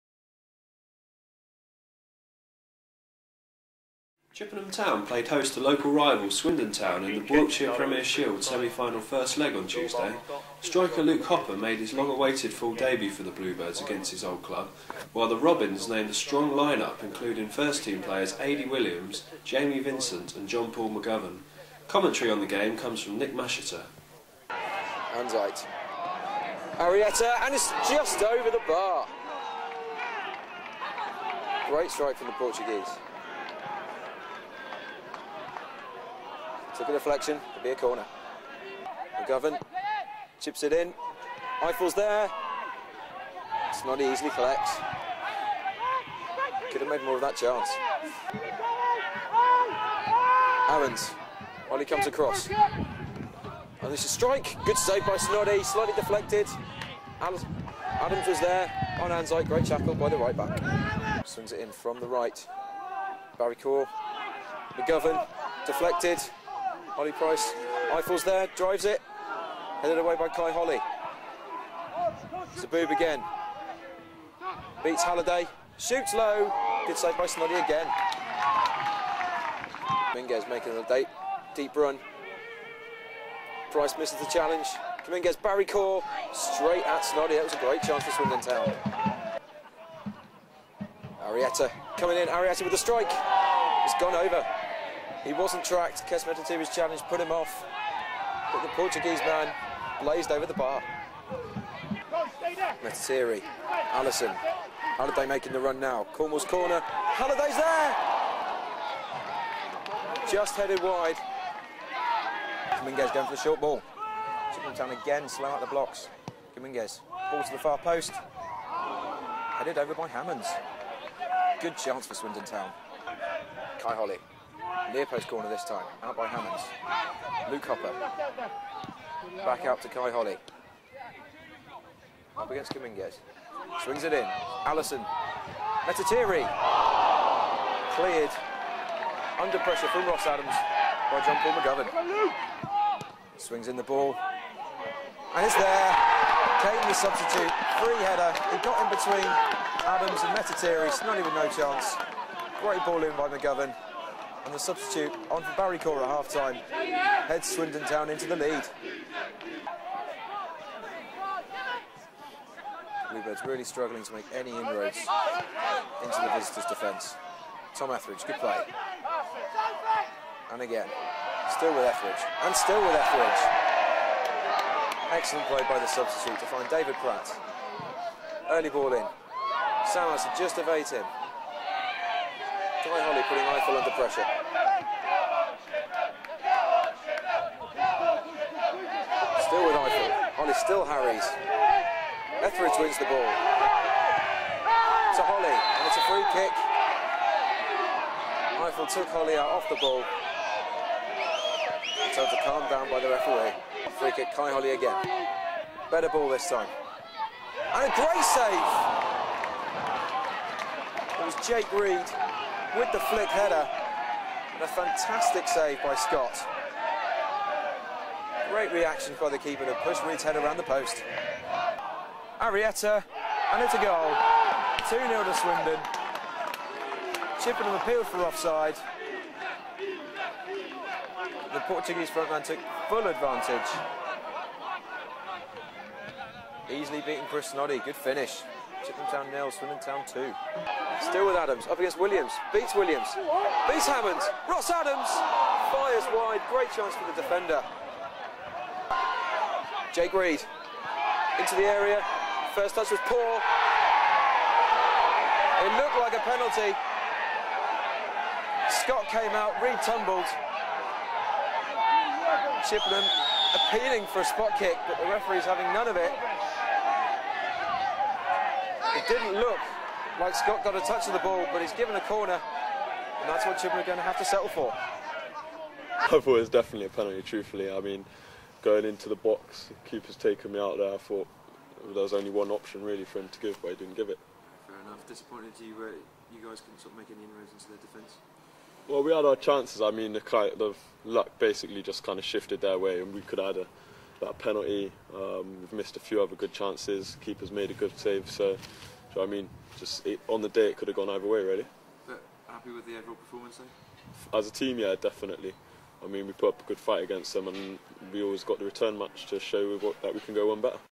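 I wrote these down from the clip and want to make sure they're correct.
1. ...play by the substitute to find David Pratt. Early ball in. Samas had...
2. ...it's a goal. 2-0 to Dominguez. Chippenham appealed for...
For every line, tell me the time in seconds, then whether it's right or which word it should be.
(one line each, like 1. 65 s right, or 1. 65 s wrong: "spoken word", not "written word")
1. 175 s right
2. 223 s wrong: "Swindon", not "Dominguez".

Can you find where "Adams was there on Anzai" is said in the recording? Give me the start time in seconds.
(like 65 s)
57 s.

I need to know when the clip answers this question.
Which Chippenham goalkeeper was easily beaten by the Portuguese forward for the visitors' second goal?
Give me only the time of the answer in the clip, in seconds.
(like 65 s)
237 s.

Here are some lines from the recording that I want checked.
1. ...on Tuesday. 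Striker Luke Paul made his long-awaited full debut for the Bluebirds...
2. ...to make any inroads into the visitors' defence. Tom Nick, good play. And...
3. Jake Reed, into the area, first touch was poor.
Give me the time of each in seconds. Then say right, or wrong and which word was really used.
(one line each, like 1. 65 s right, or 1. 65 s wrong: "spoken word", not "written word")
1. 9 s wrong: "Hopper", not "Paul"
2. 164 s wrong: "Etheridge", not "Nick"
3. 249 s right.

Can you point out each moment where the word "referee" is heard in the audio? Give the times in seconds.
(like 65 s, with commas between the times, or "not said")
203 s, 265 s.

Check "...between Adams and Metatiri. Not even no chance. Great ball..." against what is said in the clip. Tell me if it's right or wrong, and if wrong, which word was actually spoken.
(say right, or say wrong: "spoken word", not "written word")
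right.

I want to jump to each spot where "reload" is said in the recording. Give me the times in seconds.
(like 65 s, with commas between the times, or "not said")
not said.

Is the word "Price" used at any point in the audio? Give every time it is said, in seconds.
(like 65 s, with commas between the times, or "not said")
67 s, 83 s.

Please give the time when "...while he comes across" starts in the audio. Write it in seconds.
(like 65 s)
51 s.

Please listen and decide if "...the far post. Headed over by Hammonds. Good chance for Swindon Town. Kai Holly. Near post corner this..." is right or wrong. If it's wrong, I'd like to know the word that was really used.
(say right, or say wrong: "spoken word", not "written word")
right.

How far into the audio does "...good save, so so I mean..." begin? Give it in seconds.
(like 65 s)
297 s.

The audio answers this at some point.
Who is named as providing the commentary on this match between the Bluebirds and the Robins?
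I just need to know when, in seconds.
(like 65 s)
23 s.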